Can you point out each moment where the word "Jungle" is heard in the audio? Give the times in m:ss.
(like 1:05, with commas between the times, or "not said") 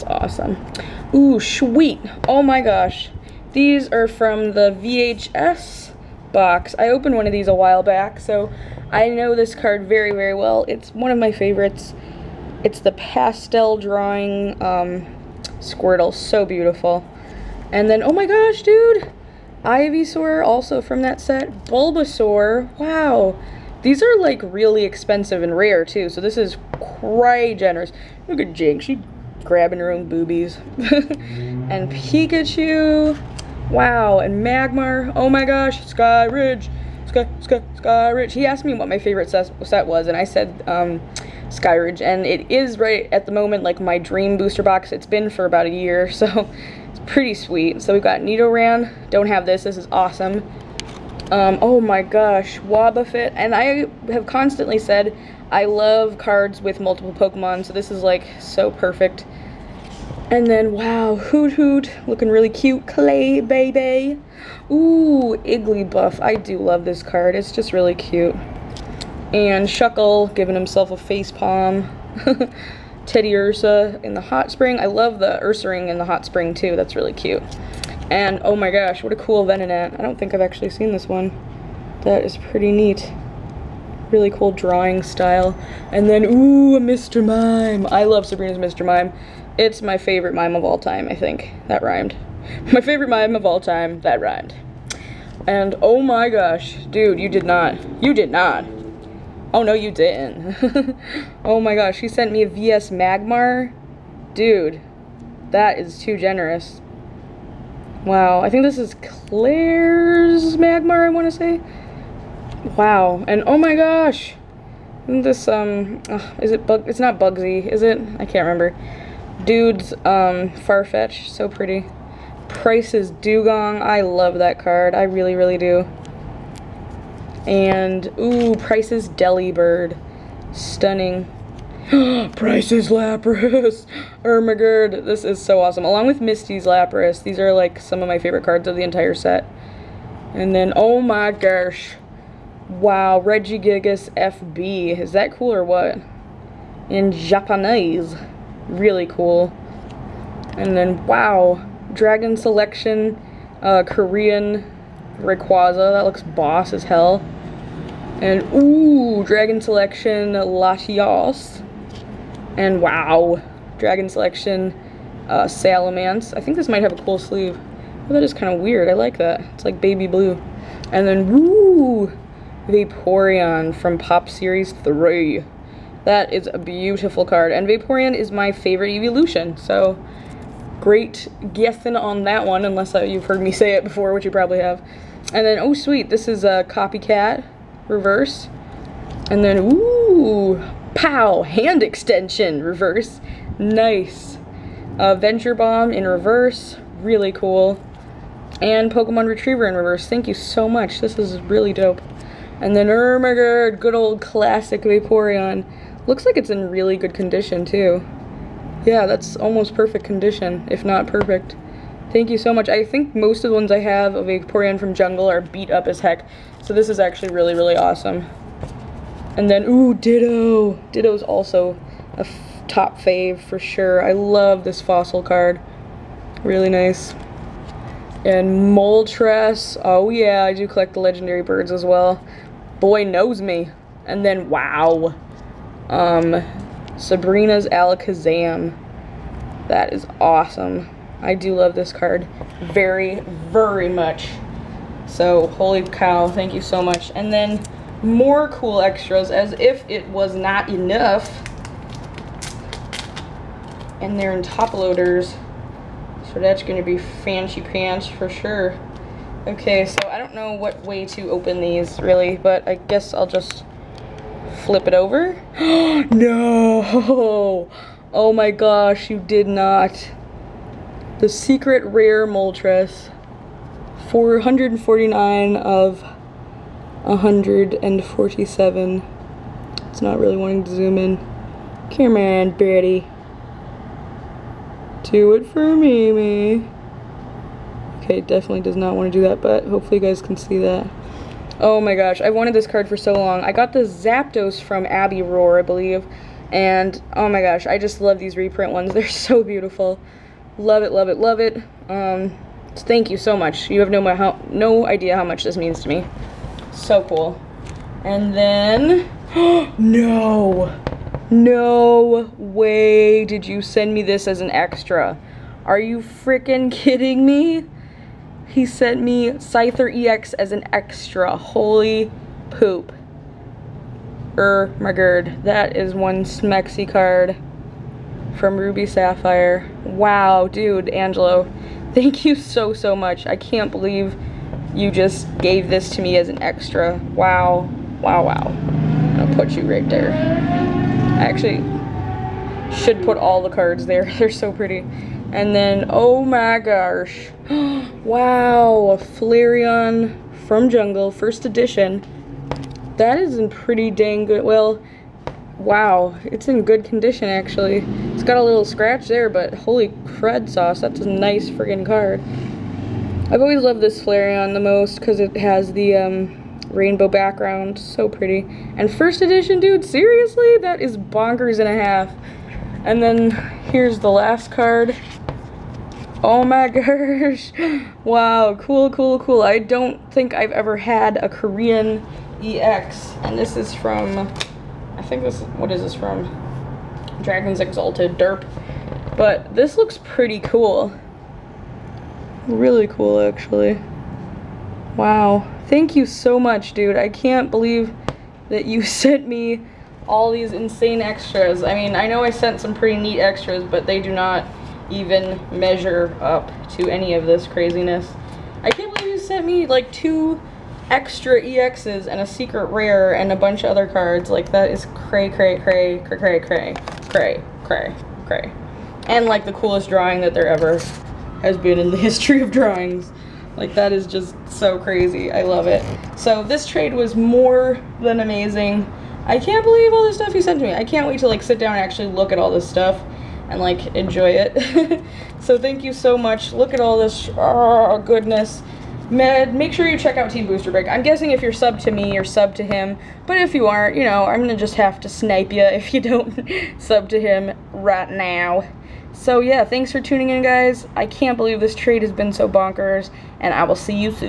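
3:34, 5:50.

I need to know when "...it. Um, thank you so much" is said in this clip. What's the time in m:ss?
5:01.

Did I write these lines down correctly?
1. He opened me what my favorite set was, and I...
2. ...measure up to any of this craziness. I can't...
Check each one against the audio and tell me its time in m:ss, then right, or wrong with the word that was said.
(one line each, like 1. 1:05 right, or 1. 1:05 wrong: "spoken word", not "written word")
1. 0:38 wrong: "asked", not "opened"
2. 6:45 right.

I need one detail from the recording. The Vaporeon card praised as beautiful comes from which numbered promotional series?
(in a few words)
Pop Series 3.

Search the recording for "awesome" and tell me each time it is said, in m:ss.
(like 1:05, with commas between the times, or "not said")
0:00, 0:49, 2:15, 3:37, 4:00.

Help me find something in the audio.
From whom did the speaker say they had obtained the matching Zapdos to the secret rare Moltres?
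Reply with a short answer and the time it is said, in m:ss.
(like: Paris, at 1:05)
Abby Roar, at 4:54.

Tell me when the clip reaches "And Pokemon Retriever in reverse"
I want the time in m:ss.
3:18.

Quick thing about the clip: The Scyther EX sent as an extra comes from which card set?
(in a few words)
Ruby Sapphire.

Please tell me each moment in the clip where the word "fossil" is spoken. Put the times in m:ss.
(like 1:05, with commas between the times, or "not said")
3:44.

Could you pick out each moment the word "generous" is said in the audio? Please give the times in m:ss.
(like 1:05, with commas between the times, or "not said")
0:27, 1:46.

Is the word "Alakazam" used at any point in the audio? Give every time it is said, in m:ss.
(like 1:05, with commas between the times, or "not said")
3:57.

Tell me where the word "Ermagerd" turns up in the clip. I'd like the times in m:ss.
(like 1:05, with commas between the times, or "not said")
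2:14, 3:22.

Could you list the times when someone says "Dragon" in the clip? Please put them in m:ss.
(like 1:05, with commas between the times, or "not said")
2:31, 2:39, 2:43, 6:27.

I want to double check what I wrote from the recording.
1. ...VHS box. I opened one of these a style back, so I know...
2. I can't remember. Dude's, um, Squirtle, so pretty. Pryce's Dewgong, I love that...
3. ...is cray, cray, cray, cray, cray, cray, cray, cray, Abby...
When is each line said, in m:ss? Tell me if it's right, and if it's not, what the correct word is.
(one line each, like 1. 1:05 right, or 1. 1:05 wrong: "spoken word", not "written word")
1. 0:04 wrong: "while", not "style"
2. 1:58 wrong: "Farfetch", not "Squirtle"
3. 6:54 wrong: "And", not "Abby".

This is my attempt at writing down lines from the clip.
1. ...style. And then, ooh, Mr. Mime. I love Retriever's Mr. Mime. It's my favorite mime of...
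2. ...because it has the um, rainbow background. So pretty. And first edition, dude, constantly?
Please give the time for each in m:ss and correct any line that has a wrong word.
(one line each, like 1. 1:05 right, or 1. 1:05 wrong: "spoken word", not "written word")
1. 1:25 wrong: "Sabrina", not "Retriever"
2. 6:04 wrong: "seriously", not "constantly".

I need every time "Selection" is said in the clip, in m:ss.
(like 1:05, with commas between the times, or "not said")
2:32, 2:39, 2:44.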